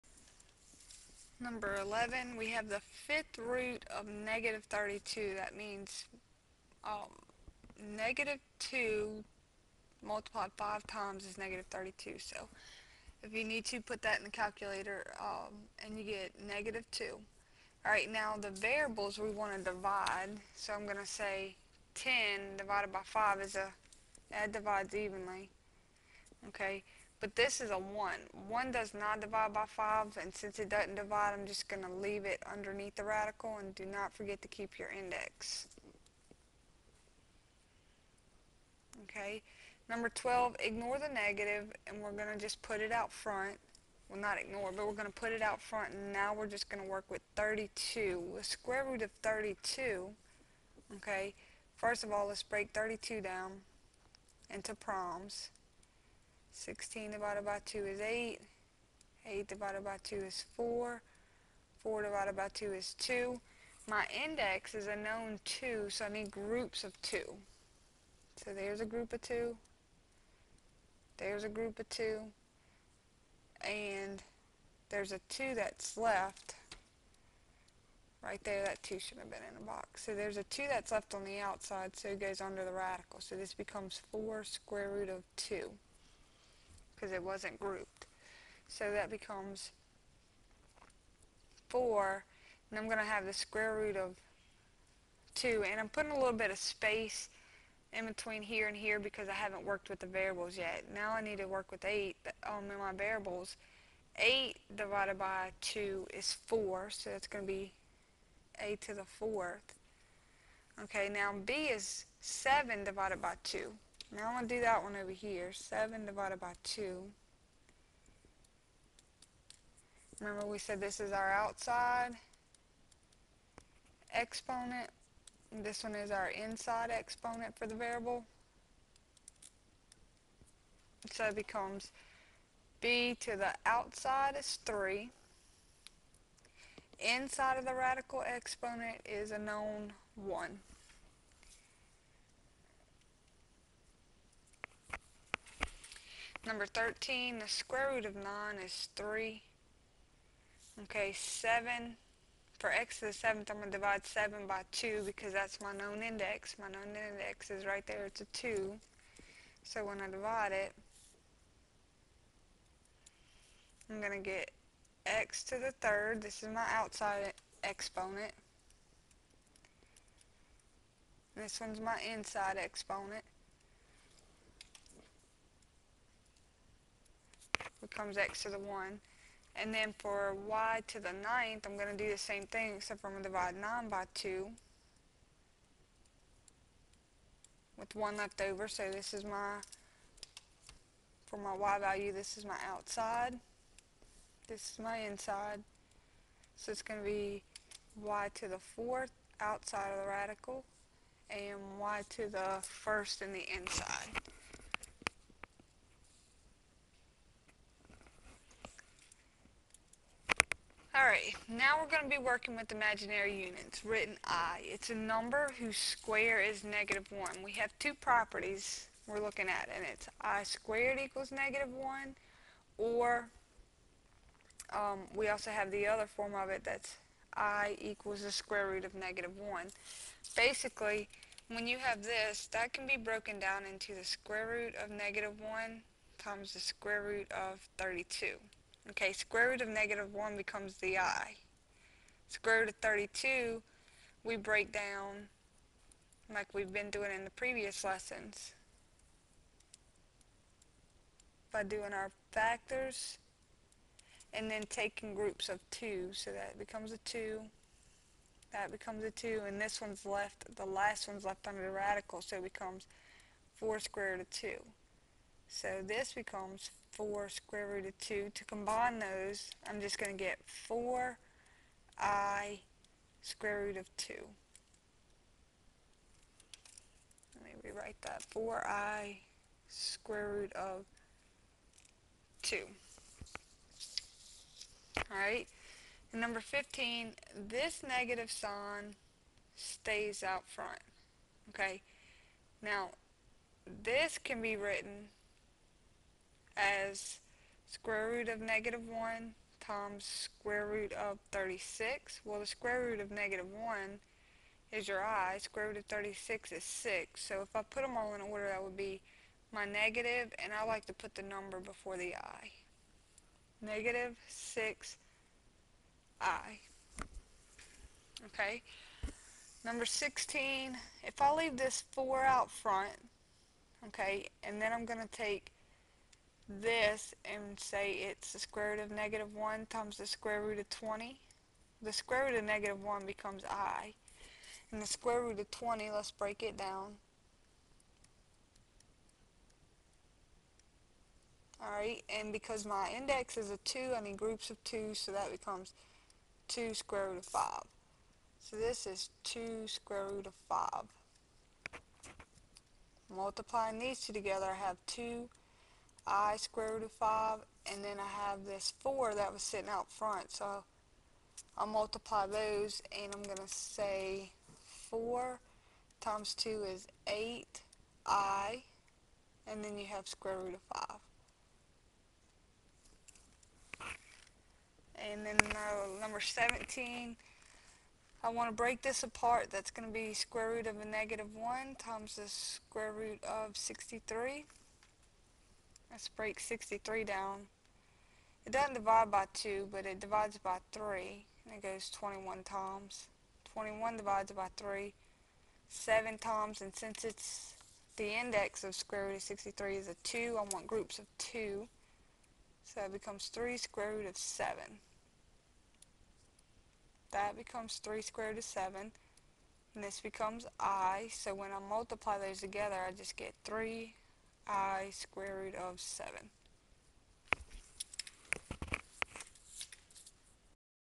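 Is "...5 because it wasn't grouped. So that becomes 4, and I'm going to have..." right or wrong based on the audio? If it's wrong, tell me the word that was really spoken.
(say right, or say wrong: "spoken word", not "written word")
wrong: "2", not "5".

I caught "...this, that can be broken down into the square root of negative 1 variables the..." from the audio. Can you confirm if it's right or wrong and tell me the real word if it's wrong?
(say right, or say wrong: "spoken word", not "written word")
wrong: "times", not "variables".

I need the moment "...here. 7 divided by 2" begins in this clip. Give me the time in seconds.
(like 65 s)
115 s.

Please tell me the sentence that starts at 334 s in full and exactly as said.
And the square root of 20, let's break it down.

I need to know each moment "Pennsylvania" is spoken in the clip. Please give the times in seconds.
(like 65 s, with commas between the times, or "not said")
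not said.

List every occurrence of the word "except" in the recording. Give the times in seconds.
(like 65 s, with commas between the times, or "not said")
182 s.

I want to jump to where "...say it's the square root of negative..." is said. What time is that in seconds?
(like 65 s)
327 s.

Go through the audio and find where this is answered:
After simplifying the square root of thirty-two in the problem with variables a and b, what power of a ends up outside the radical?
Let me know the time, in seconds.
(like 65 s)
108 s.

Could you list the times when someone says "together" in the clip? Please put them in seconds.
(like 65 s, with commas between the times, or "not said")
354 s, 412 s.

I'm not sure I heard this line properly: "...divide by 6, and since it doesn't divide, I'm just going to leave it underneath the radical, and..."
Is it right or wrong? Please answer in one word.
wrong.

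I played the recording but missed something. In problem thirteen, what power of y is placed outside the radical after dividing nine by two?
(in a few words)
y to the 4th.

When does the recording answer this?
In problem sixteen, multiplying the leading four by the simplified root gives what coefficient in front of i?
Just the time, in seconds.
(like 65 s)
367 s.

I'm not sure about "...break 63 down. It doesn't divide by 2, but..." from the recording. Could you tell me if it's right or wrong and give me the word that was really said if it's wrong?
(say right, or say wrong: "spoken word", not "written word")
right.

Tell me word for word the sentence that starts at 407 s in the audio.
That becomes 3 square root of 7.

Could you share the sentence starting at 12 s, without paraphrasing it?
So if you need to, put that in the calculator um, and you get negative 2.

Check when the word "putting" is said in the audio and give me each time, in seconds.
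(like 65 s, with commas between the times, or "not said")
95 s.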